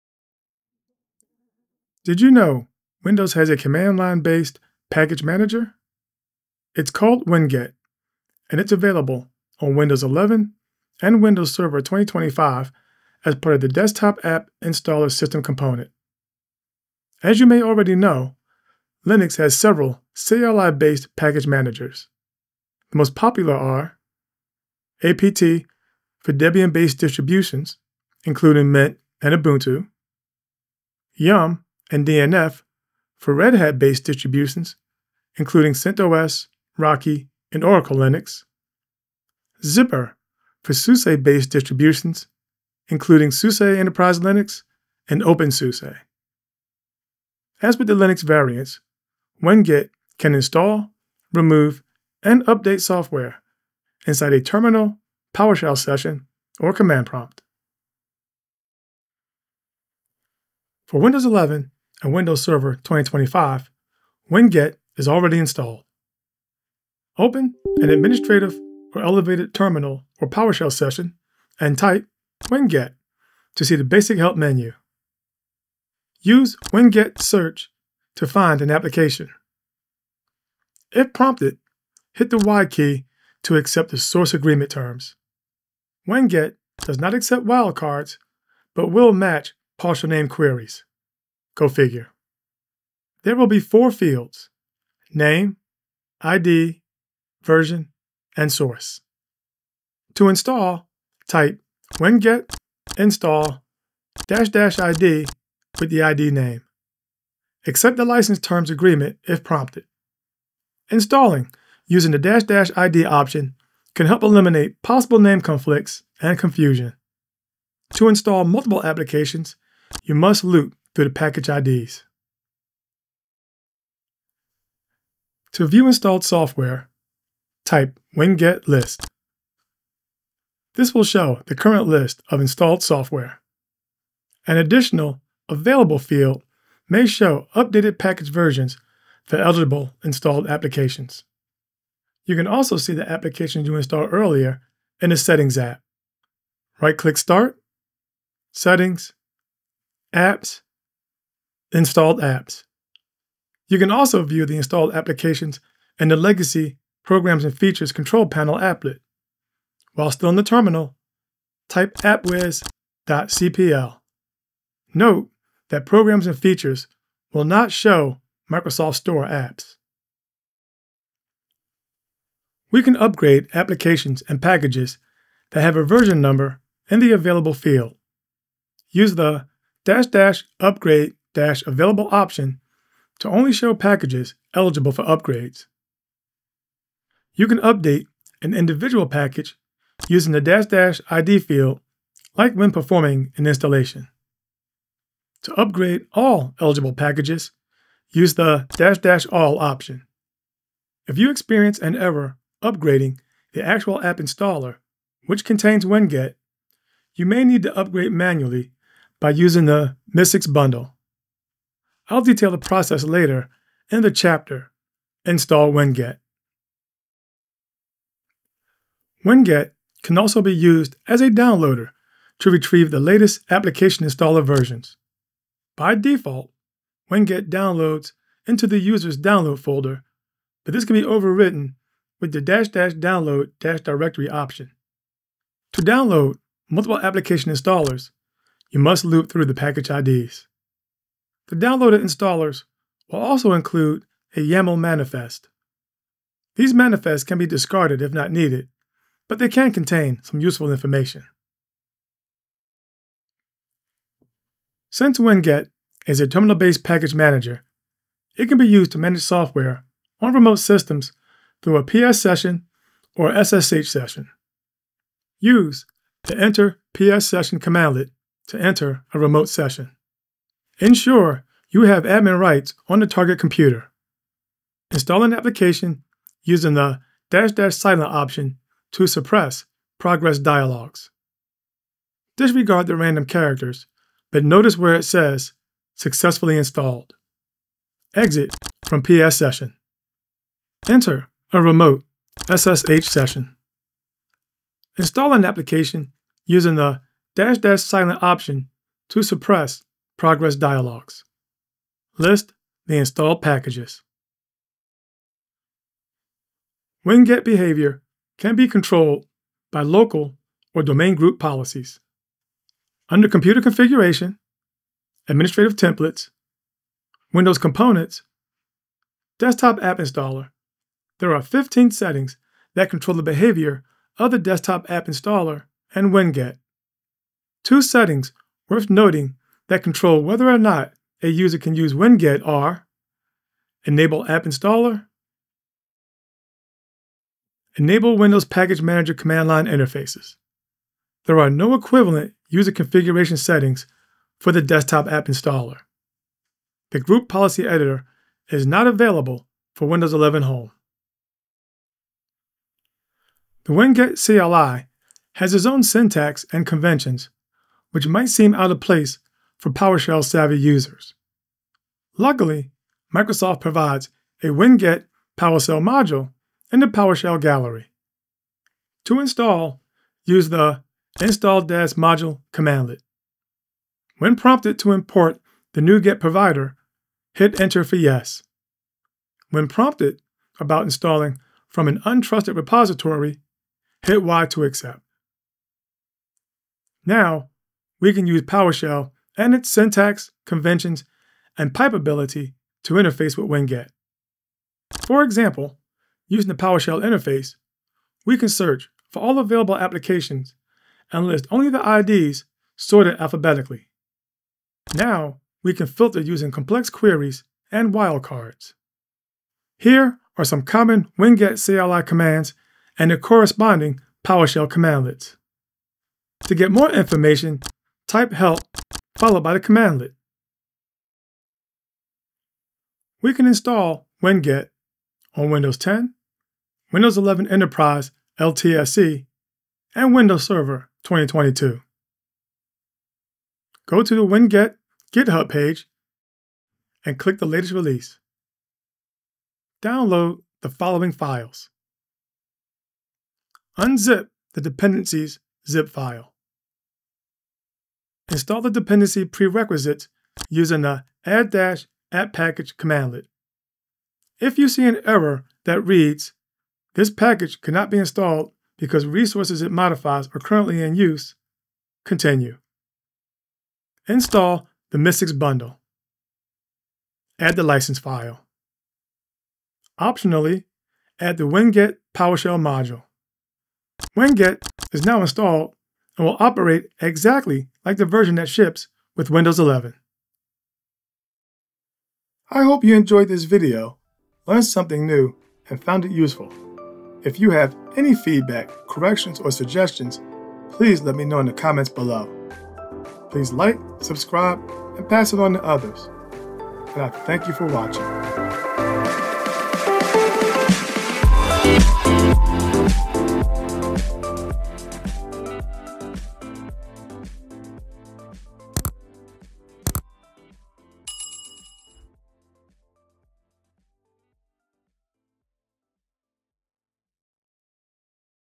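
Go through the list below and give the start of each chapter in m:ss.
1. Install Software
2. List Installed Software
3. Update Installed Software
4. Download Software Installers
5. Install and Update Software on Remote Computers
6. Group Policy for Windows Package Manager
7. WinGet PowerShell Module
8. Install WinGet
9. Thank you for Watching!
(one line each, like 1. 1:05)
1. 0:58
2. 2:03
3. 2:50
4. 3:37
5. 4:12
6. 5:05
7. 5:51
8. 7:01
9. 8:01.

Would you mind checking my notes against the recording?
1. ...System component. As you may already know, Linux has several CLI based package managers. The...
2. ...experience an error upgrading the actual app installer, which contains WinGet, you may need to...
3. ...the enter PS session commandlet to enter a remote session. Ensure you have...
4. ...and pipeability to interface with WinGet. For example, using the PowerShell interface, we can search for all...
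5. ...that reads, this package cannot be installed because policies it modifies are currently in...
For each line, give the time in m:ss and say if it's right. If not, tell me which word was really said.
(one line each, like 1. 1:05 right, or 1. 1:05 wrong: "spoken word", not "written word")
1. 0:15 right
2. 3:21 right
3. 4:26 right
4. 6:31 right
5. 7:35 wrong: "resources", not "policies".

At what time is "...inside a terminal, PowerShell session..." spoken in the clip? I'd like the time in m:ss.
0:54.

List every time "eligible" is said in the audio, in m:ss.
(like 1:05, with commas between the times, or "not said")
2:19, 3:04, 3:16.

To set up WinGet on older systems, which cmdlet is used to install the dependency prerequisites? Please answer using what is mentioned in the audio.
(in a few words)
add app package.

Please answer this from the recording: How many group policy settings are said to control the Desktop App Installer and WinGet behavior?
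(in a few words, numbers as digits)
15.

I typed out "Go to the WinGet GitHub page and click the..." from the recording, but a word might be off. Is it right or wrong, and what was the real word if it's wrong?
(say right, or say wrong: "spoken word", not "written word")
right.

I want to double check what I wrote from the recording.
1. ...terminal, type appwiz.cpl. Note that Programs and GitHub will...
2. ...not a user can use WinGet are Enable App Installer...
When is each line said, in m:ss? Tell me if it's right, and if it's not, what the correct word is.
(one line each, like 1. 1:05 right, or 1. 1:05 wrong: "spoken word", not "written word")
1. 2:40 wrong: "Features", not "GitHub"
2. 5:30 right.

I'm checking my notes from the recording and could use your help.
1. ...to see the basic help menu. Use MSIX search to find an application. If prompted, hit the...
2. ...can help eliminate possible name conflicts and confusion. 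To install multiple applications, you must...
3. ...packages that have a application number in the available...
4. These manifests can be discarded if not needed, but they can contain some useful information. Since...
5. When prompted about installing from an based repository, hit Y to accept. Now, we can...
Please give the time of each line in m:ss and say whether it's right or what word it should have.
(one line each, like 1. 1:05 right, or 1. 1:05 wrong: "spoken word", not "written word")
1. 1:13 wrong: "WinGet", not "MSIX"
2. 1:53 right
3. 2:54 wrong: "version", not "application"
4. 4:06 right
5. 6:19 wrong: "untrusted", not "based".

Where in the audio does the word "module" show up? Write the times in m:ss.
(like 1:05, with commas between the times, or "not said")
6:05, 6:11, 7:52.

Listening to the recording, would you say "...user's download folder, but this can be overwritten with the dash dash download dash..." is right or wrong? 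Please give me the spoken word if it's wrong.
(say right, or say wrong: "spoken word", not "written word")
right.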